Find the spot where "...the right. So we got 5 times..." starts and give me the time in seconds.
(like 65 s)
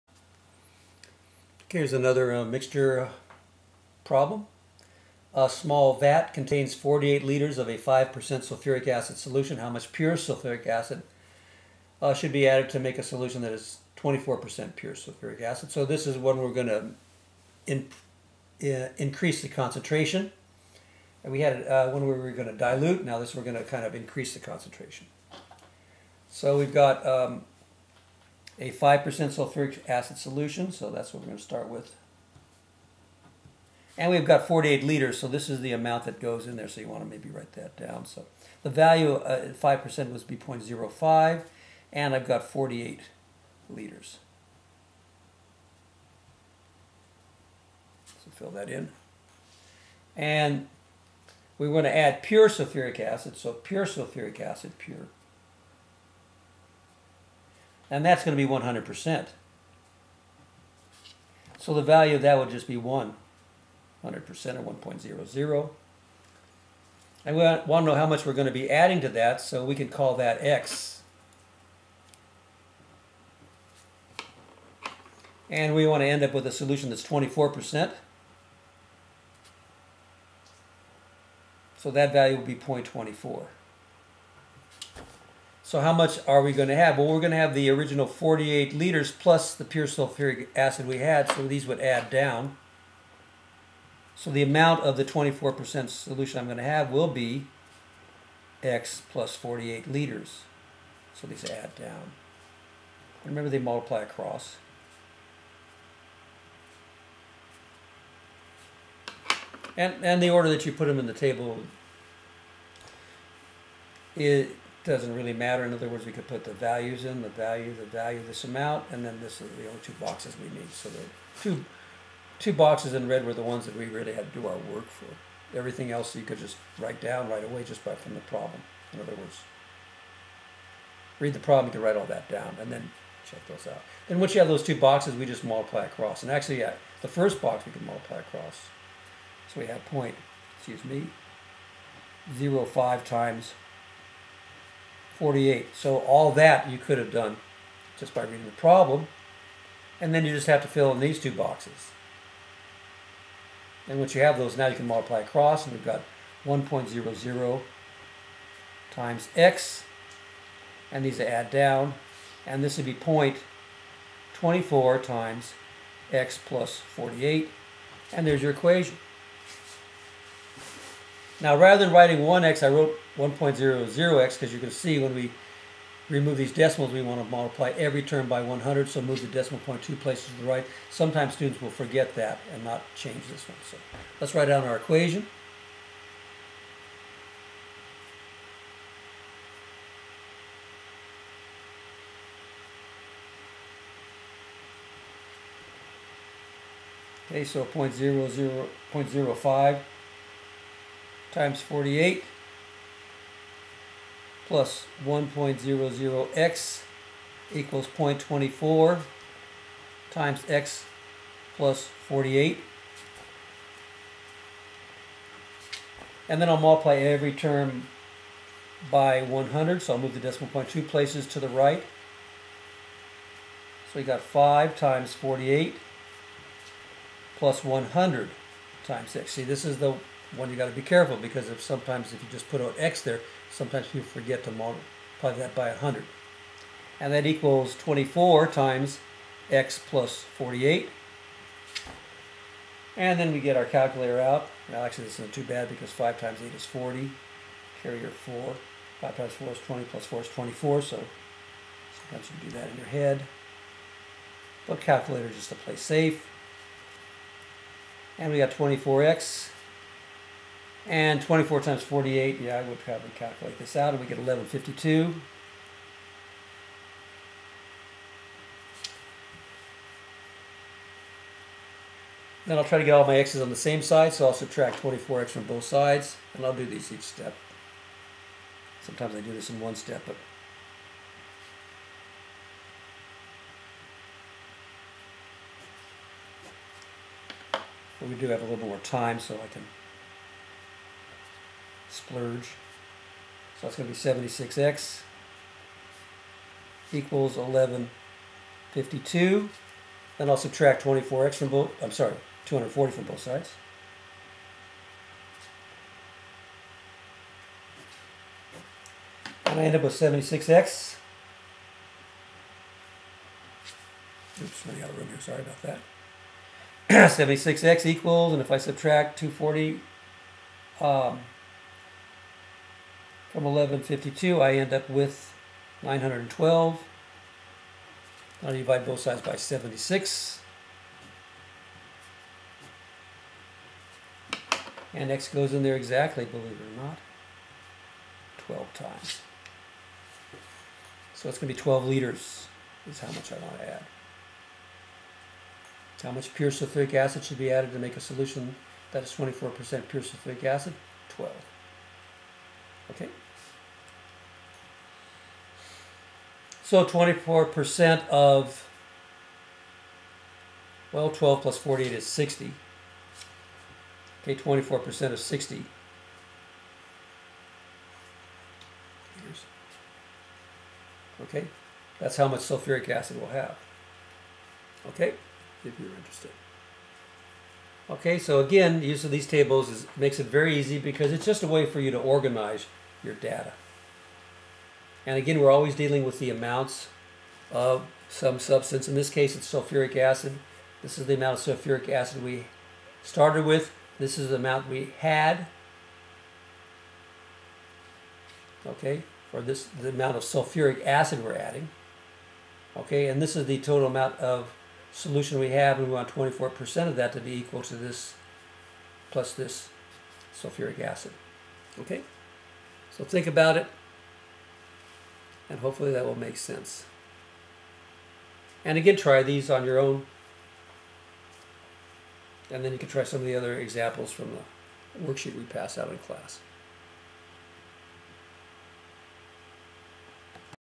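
221 s.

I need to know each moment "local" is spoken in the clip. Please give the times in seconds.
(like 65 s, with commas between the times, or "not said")
not said.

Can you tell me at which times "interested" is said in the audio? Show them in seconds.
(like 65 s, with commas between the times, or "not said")
375 s.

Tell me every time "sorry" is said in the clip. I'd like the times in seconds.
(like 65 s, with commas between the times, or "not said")
301 s, 315 s.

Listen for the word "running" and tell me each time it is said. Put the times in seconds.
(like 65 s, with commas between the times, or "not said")
314 s.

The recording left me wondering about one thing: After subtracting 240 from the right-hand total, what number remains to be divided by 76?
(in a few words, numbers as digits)
912.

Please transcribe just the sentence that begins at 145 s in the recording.
So all that you could have done just by reading the problem.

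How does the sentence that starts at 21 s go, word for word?
And we had uh, one we were going to dilute.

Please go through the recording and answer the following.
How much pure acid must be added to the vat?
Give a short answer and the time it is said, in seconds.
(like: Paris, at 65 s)
12 liters, at 341 s.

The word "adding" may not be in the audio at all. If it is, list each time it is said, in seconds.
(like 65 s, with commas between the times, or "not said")
68 s, 401 s.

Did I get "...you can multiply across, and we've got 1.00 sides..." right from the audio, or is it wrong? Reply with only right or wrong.
wrong.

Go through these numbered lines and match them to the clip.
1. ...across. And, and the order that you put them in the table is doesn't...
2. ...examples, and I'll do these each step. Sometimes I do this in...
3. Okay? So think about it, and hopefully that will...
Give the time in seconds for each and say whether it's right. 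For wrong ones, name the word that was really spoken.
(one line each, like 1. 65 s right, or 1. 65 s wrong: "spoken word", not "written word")
1. 104 s right
2. 275 s wrong: "sides", not "examples"
3. 411 s right.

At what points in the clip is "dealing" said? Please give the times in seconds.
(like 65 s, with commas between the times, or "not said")
385 s.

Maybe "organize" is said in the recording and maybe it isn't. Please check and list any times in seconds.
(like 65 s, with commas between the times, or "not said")
381 s.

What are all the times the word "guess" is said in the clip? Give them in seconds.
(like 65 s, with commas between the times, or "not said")
not said.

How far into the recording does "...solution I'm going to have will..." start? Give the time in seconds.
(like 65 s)
95 s.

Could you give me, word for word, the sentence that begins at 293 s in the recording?
So that's going to be 76x equals 1152.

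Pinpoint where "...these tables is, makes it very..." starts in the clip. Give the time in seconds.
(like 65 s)
379 s.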